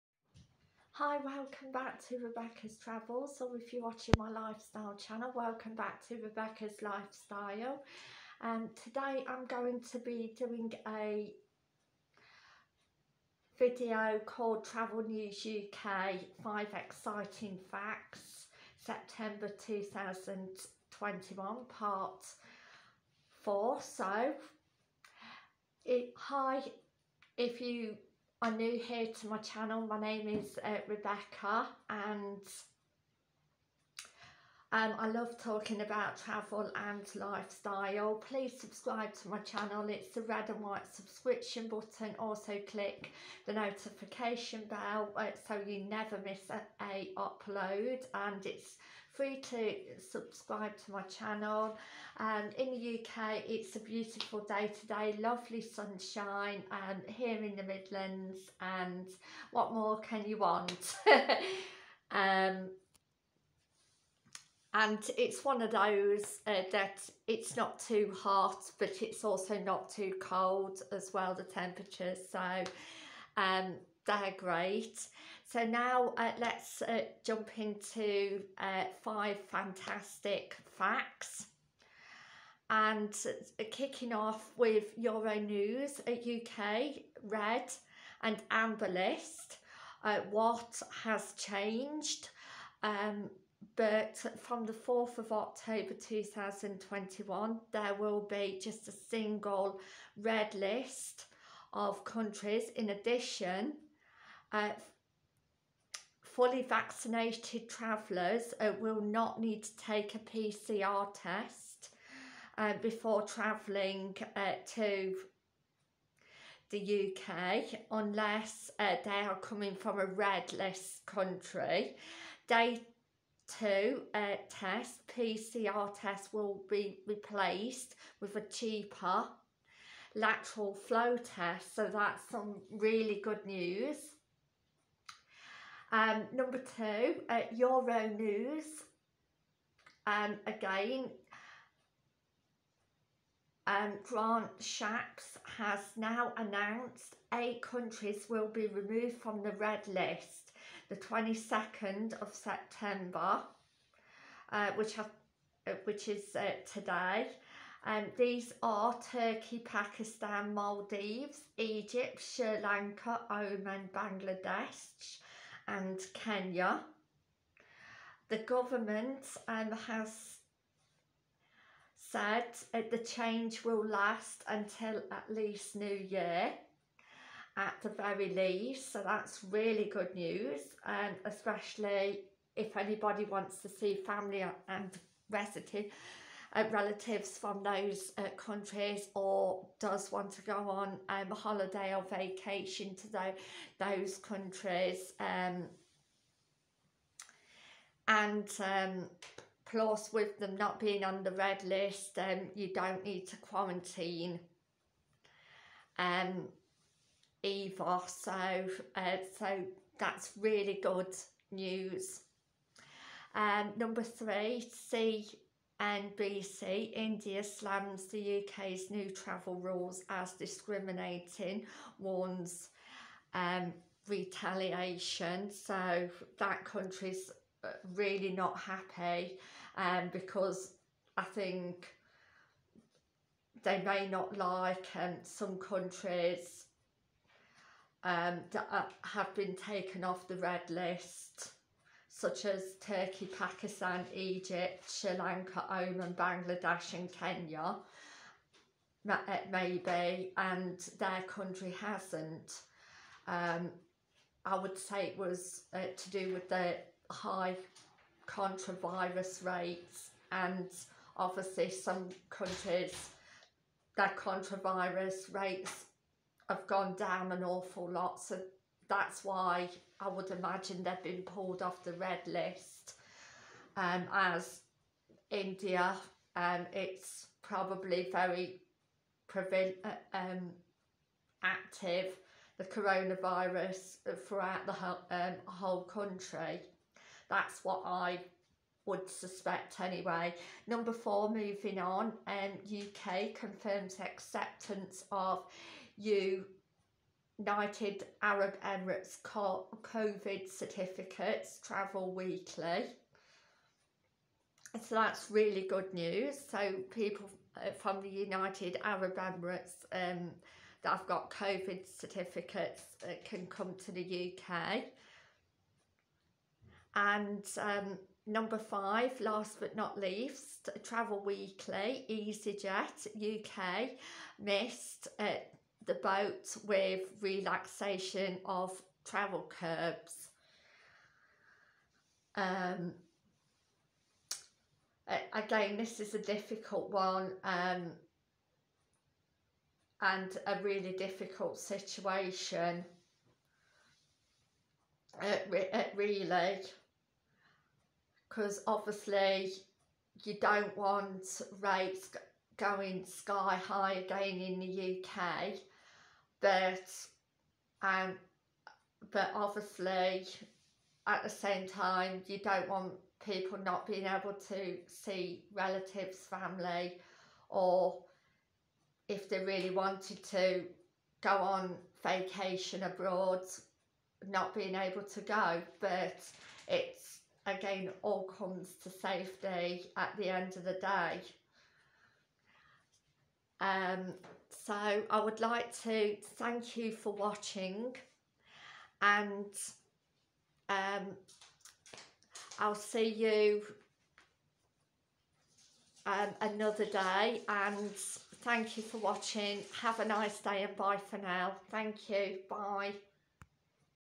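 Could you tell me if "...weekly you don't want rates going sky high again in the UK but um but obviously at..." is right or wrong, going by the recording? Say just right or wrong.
wrong.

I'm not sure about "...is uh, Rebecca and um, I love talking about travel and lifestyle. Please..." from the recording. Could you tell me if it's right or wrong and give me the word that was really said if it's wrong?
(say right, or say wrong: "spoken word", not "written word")
right.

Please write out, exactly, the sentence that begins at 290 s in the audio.
Number four, moving on, um, UK confirms acceptance of U United Arab Emirates COVID certificates travel weekly.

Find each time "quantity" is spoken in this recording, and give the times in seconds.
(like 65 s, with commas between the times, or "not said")
not said.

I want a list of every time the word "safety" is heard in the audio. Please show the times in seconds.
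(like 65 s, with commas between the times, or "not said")
378 s.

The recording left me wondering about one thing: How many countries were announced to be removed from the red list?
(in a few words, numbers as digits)
8.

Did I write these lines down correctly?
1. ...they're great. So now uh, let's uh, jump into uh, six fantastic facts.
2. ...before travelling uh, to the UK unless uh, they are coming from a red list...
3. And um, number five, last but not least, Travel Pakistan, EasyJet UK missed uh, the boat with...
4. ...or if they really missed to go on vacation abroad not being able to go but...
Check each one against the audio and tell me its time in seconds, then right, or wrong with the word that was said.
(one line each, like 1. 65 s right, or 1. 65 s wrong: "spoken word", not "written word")
1. 74 s wrong: "five", not "six"
2. 112 s right
3. 316 s wrong: "Weekly", not "Pakistan"
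4. 367 s wrong: "wanted", not "missed".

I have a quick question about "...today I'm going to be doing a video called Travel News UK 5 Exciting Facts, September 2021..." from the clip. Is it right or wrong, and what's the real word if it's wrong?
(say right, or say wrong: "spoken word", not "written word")
right.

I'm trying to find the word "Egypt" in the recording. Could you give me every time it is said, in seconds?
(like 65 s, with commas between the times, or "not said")
161 s, 244 s.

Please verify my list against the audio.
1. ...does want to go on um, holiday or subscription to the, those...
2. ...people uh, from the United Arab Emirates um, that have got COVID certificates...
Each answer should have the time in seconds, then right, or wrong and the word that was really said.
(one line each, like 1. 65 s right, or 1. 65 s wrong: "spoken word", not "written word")
1. 189 s wrong: "vacation", not "subscription"
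2. 306 s right.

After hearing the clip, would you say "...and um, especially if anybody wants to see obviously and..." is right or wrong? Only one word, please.
wrong.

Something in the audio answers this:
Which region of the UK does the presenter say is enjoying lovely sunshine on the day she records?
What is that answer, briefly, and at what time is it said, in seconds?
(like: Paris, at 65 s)
the Midlands, at 57 s.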